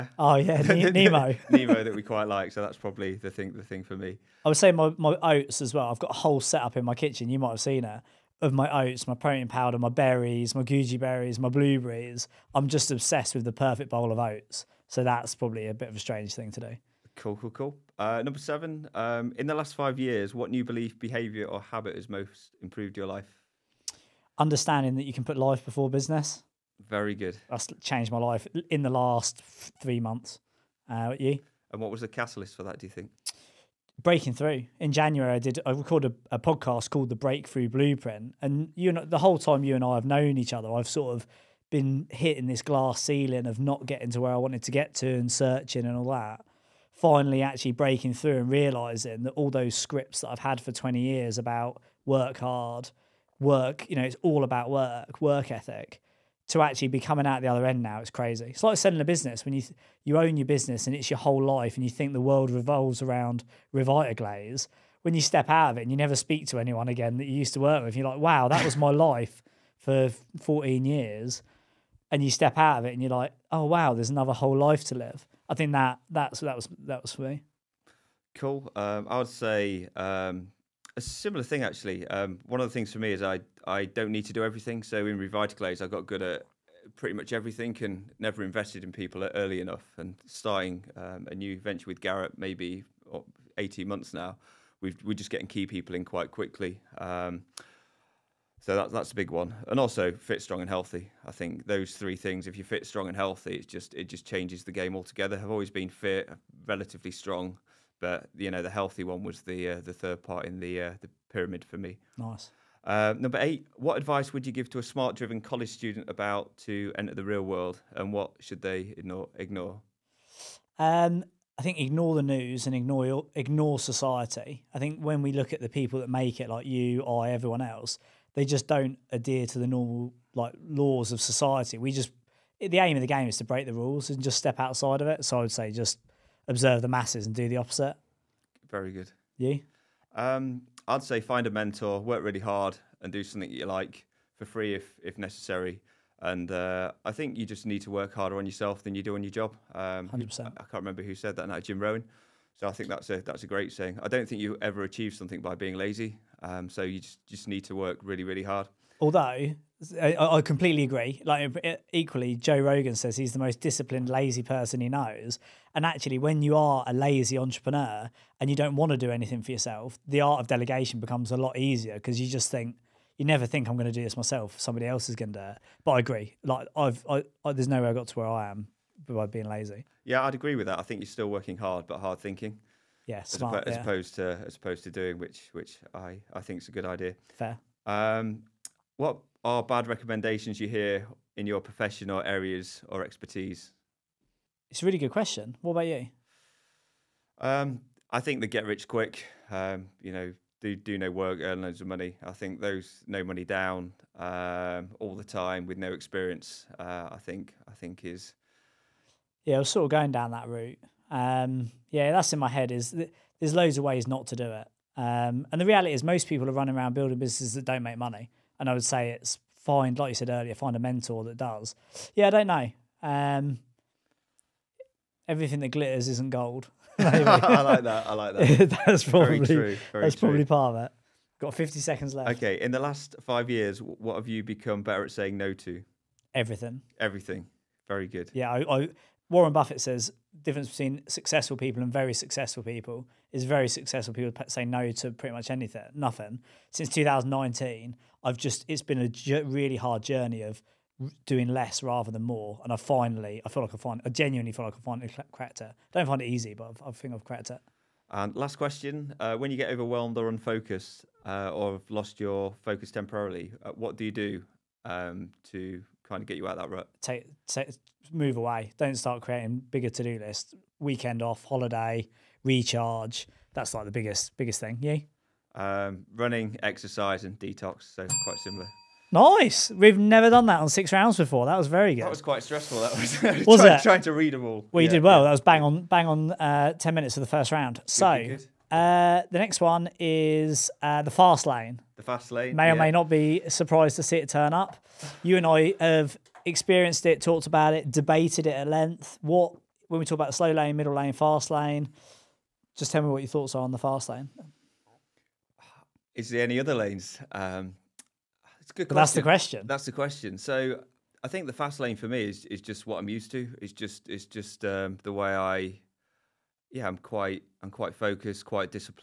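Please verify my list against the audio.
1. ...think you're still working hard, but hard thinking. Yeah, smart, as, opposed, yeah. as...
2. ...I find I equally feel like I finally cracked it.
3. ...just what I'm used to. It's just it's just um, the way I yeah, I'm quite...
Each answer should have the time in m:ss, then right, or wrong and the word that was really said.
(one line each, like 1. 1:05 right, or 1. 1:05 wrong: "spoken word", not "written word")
1. 3:00 right
2. 4:13 wrong: "genuinely", not "equally"
3. 5:12 right.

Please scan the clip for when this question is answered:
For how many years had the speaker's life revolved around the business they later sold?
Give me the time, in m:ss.
1:10.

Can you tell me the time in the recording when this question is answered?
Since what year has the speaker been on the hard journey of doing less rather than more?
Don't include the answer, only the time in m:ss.
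4:06.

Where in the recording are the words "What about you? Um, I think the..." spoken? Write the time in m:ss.
3:15.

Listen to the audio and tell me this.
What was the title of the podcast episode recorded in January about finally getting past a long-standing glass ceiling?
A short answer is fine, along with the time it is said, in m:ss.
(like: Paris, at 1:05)
The Breakthrough Blueprint, at 0:37.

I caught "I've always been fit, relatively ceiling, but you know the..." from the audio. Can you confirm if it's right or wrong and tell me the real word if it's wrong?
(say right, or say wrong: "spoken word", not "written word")
wrong: "strong", not "ceiling".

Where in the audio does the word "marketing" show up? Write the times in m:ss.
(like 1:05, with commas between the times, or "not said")
not said.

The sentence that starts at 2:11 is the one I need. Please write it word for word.
We just the aim of the game is to break the rules and just step outside of it.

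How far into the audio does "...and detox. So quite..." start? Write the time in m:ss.
4:37.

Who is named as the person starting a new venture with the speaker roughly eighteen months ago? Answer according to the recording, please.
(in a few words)
Garrett.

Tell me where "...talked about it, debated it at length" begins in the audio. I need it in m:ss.
4:57.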